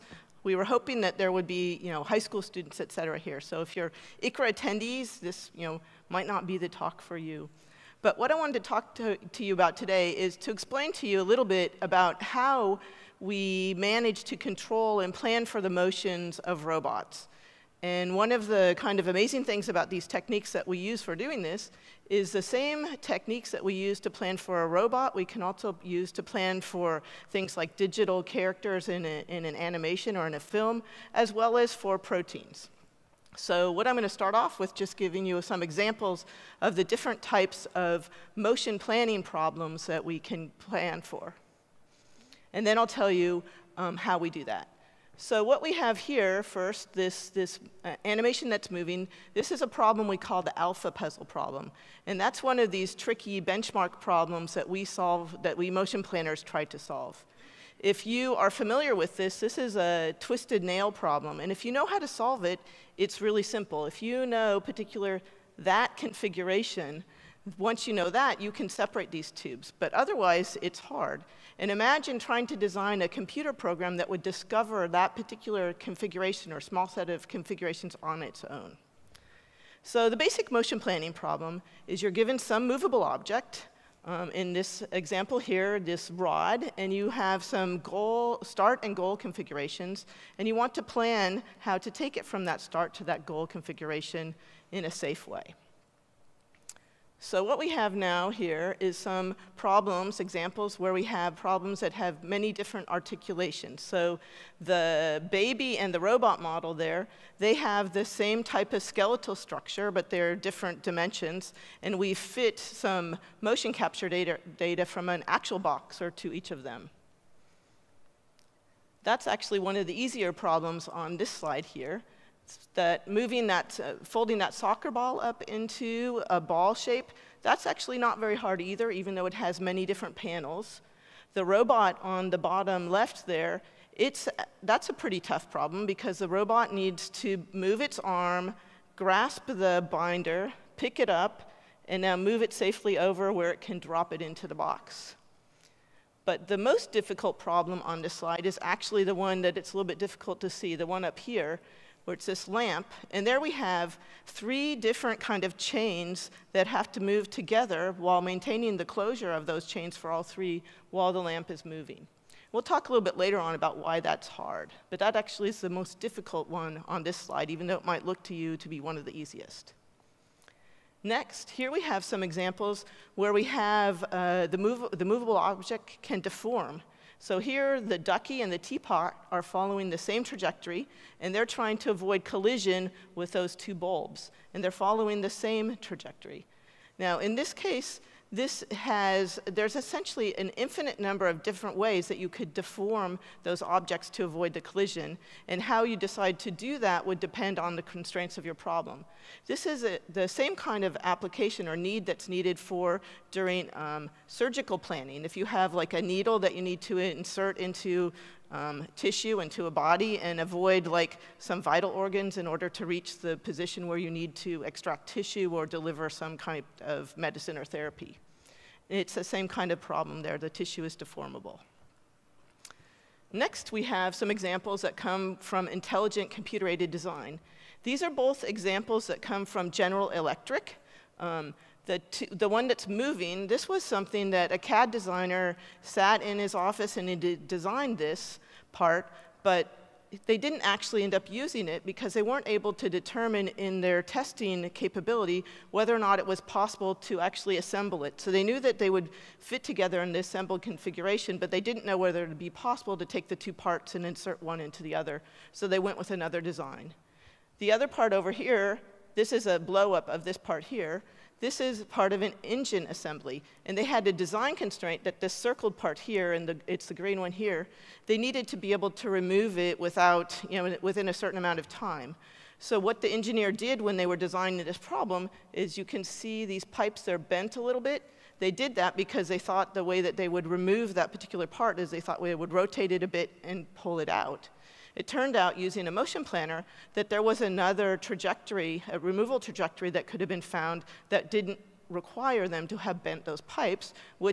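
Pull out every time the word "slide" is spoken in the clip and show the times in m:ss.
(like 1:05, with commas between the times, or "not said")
2:01, 2:28, 2:47.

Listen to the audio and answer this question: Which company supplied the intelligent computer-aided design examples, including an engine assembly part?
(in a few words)
General Electric.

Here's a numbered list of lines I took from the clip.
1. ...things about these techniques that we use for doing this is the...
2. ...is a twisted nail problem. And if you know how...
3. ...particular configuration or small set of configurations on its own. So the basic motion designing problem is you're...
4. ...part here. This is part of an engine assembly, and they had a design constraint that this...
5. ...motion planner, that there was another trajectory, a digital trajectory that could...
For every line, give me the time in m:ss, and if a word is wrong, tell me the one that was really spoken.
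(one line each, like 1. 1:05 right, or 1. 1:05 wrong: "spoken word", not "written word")
1. 0:19 right
2. 0:59 right
3. 1:15 wrong: "planning", not "designing"
4. 4:20 right
5. 4:45 wrong: "removal", not "digital".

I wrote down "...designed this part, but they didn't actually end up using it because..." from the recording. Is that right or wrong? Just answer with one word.
right.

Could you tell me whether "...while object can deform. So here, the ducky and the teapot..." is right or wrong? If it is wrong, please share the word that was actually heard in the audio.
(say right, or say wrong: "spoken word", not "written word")
wrong: "movable", not "while".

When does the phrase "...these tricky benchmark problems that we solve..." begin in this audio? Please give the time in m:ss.
0:52.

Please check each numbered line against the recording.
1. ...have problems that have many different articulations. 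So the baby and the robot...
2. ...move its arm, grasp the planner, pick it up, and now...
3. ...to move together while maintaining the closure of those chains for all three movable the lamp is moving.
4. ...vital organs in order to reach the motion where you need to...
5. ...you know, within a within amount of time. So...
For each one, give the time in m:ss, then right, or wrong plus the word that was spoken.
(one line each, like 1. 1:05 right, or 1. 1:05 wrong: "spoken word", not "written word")
1. 1:41 right
2. 2:17 wrong: "binder", not "planner"
3. 2:36 wrong: "while", not "movable"
4. 3:31 wrong: "position", not "motion"
5. 4:30 wrong: "certain", not "within".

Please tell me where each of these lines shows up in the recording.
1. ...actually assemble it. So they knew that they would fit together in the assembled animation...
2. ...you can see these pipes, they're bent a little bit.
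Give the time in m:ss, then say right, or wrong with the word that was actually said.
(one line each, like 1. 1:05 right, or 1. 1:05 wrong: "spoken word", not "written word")
1. 4:07 wrong: "configuration", not "animation"
2. 4:35 right.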